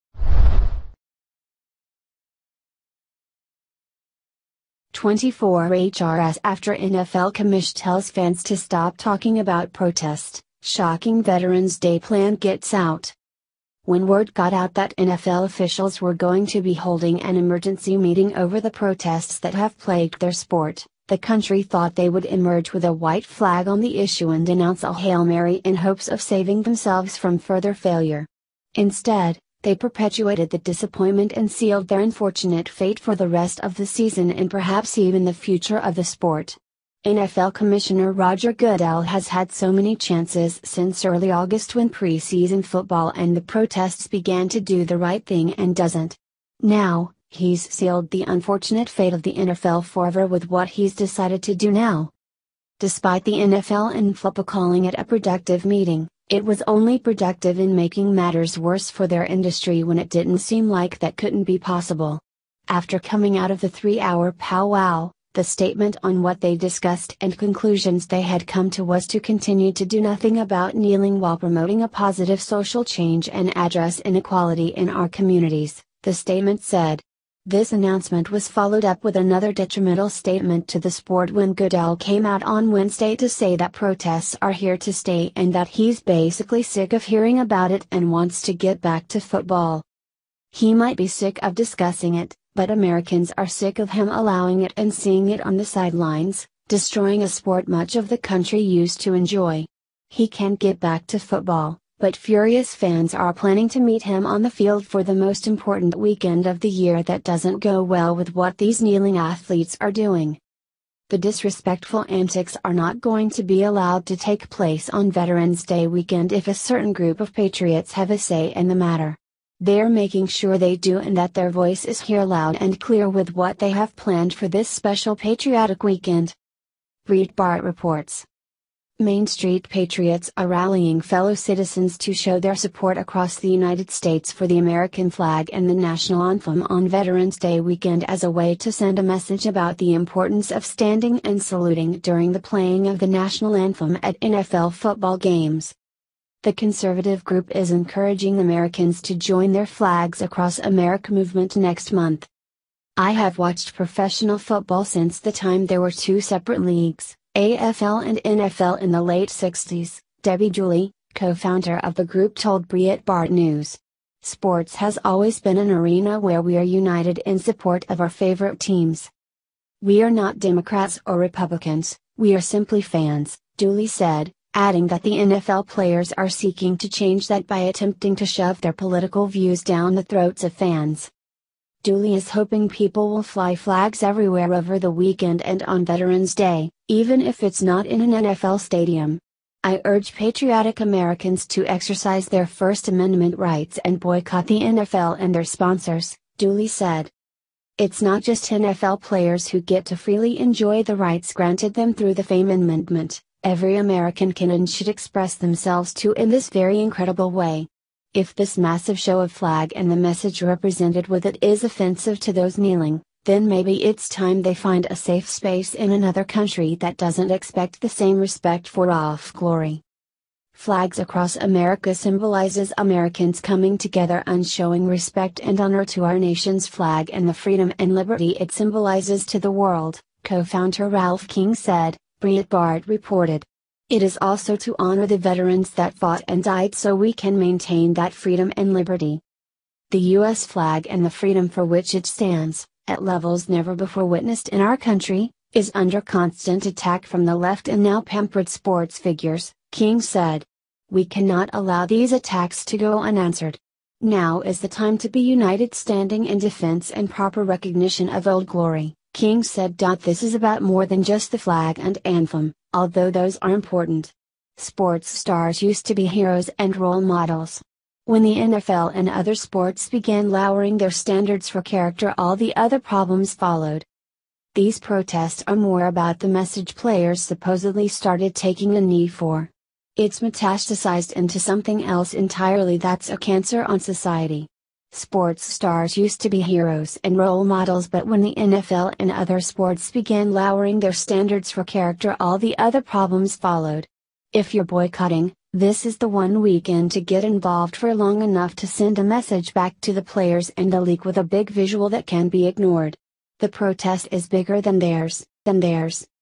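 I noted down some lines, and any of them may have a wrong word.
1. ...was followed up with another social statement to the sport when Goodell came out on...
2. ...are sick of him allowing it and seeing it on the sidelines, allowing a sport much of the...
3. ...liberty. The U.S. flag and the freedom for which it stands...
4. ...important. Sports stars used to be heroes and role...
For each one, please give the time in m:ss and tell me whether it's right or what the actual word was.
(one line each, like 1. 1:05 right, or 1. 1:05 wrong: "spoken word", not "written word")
1. 1:18 wrong: "detrimental", not "social"
2. 1:33 wrong: "destroying", not "allowing"
3. 3:58 right
4. 4:23 right.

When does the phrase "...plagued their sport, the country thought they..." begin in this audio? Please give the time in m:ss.
0:19.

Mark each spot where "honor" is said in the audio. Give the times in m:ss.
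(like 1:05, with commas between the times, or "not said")
3:45, 3:54.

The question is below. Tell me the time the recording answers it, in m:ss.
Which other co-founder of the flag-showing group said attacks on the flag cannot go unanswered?
3:50.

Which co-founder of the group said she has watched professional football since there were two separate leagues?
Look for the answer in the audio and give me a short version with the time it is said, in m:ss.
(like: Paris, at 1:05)
Debbie Dooley, at 2:40.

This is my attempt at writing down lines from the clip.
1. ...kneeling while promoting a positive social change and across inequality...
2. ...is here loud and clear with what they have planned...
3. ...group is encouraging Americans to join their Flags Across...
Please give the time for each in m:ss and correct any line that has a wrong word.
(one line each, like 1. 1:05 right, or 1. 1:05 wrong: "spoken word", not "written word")
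1. 1:10 wrong: "address", not "across"
2. 2:01 right
3. 2:27 right.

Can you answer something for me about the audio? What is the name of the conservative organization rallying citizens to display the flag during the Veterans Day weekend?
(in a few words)
Main Street Patriots.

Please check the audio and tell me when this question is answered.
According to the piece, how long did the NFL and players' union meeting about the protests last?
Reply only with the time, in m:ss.
1:03.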